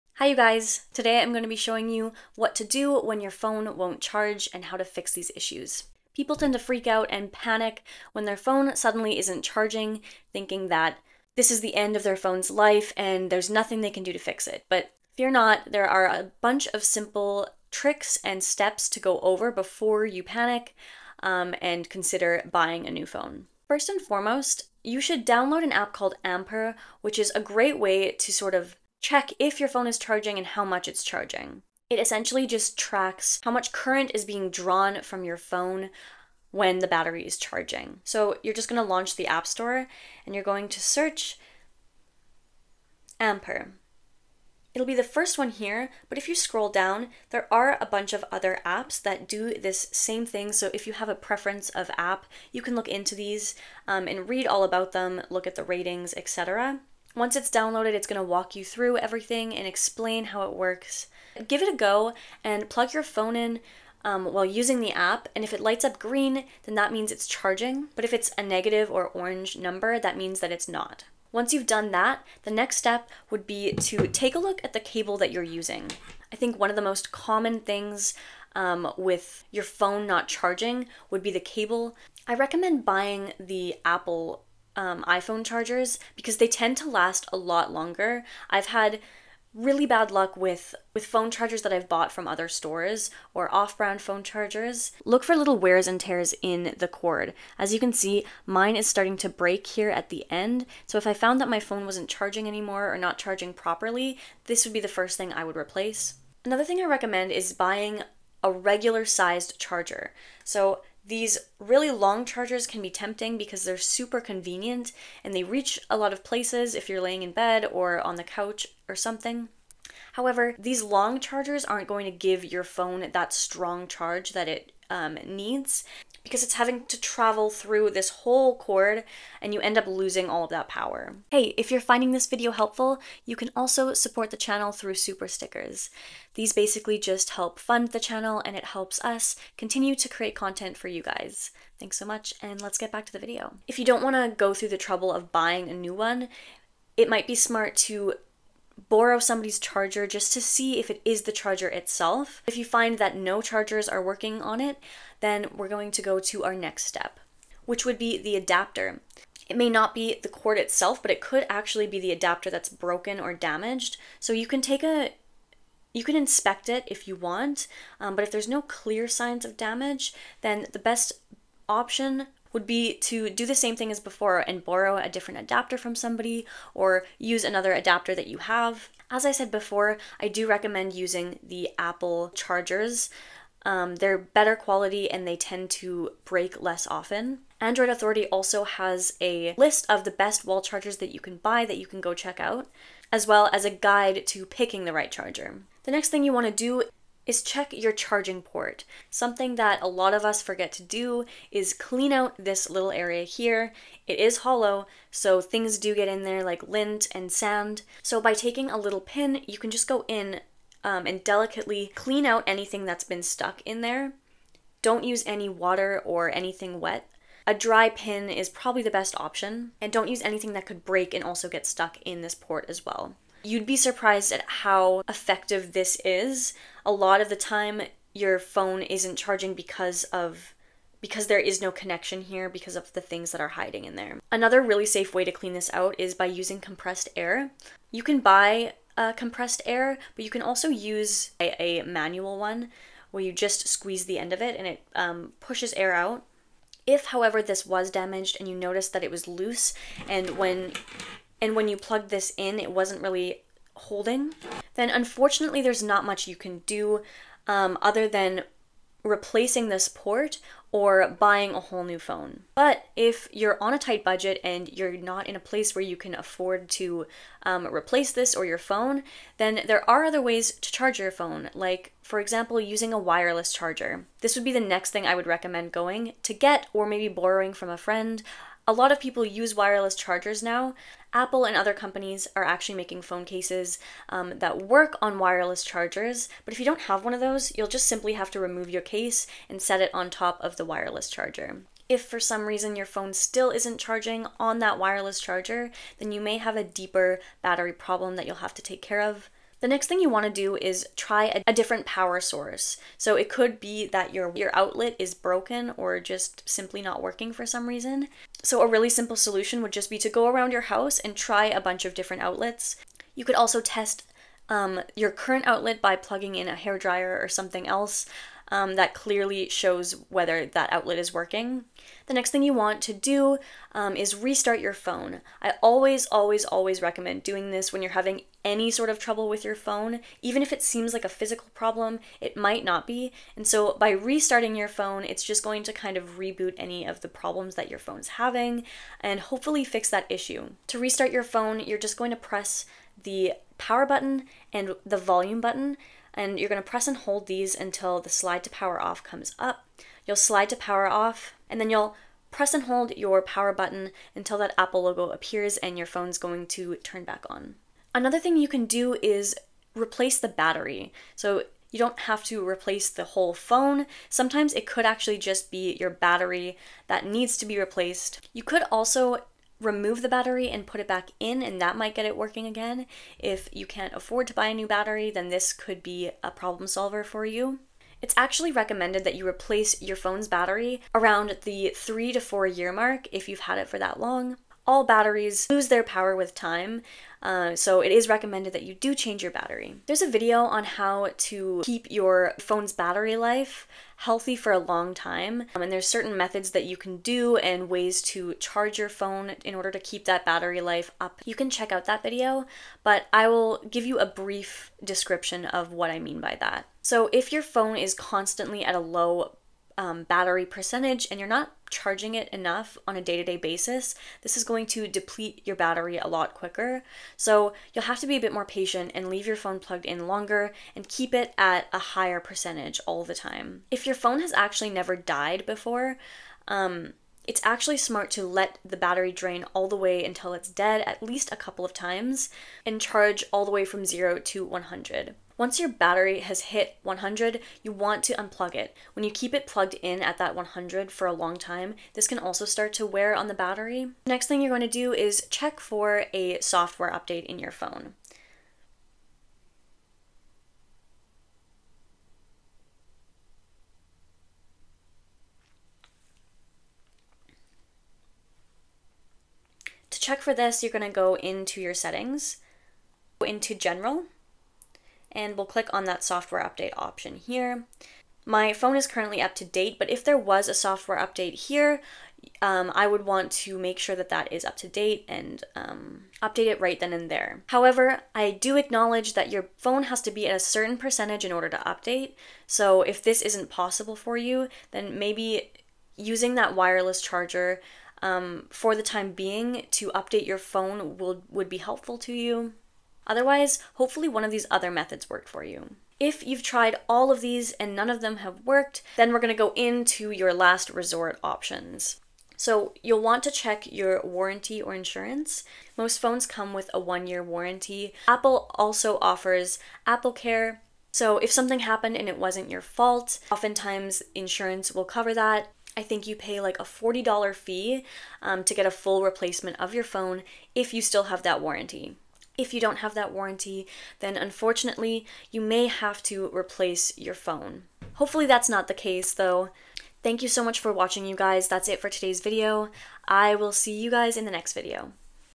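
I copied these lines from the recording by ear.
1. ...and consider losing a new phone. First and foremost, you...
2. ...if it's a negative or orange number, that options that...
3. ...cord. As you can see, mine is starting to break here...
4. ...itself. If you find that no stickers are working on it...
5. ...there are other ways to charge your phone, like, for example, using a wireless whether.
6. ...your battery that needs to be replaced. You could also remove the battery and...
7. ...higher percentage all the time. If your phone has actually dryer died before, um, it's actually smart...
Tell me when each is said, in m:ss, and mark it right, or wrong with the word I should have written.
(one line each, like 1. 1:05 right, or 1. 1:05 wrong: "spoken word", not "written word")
1. 0:21 wrong: "buying", not "losing"
2. 1:08 wrong: "means", not "options"
3. 1:36 right
4. 2:31 wrong: "chargers", not "stickers"
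5. 4:29 wrong: "charger", not "whether"
6. 6:05 right
7. 7:01 wrong: "never", not "dryer".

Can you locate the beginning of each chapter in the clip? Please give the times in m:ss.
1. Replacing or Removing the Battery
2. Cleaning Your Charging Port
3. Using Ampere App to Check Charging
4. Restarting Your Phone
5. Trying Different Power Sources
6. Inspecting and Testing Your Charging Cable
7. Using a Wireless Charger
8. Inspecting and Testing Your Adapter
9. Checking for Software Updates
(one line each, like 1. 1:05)
1. 5:59
2. 3:16
3. 0:24
4. 5:22
5. 5:00
6. 1:13
7. 4:22
8. 2:32
9. 7:24.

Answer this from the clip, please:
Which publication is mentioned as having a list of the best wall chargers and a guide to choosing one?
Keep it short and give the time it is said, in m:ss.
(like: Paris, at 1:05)
Android Authority, at 3:07.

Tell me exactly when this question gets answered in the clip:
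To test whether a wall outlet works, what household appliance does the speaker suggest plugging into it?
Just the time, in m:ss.
5:16.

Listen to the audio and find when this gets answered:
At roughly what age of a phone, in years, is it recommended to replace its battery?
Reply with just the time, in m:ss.
6:21.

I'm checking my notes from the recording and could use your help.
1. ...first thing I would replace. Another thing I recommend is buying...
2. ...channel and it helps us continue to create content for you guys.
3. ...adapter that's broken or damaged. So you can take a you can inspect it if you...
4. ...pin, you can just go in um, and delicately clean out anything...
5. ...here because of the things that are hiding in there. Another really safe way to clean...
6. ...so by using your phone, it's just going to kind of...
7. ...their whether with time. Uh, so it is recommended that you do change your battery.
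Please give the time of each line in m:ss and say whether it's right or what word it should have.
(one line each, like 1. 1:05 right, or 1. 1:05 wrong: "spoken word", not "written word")
1. 1:44 right
2. 2:17 right
3. 2:42 right
4. 3:29 right
5. 3:52 right
6. 5:33 wrong: "restarting", not "using"
7. 6:25 wrong: "power", not "whether".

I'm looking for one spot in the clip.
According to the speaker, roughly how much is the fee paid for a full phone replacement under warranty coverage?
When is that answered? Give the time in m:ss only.
8:36.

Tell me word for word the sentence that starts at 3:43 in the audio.
You'd be surprised at how effective this is.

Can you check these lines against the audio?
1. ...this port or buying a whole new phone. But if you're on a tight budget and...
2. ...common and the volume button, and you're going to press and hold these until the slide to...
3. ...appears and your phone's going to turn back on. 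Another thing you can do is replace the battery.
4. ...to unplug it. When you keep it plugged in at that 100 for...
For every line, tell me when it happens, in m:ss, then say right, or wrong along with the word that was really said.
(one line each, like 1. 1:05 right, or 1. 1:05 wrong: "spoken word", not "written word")
1. 4:19 right
2. 5:43 wrong: "button", not "common"
3. 5:55 right
4. 7:18 right.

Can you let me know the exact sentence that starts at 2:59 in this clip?
As I said before, I do recommend using the Apple chargers.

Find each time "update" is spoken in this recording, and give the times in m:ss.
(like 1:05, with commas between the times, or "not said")
7:26, 7:46, 7:50, 7:56, 8:01, 8:09.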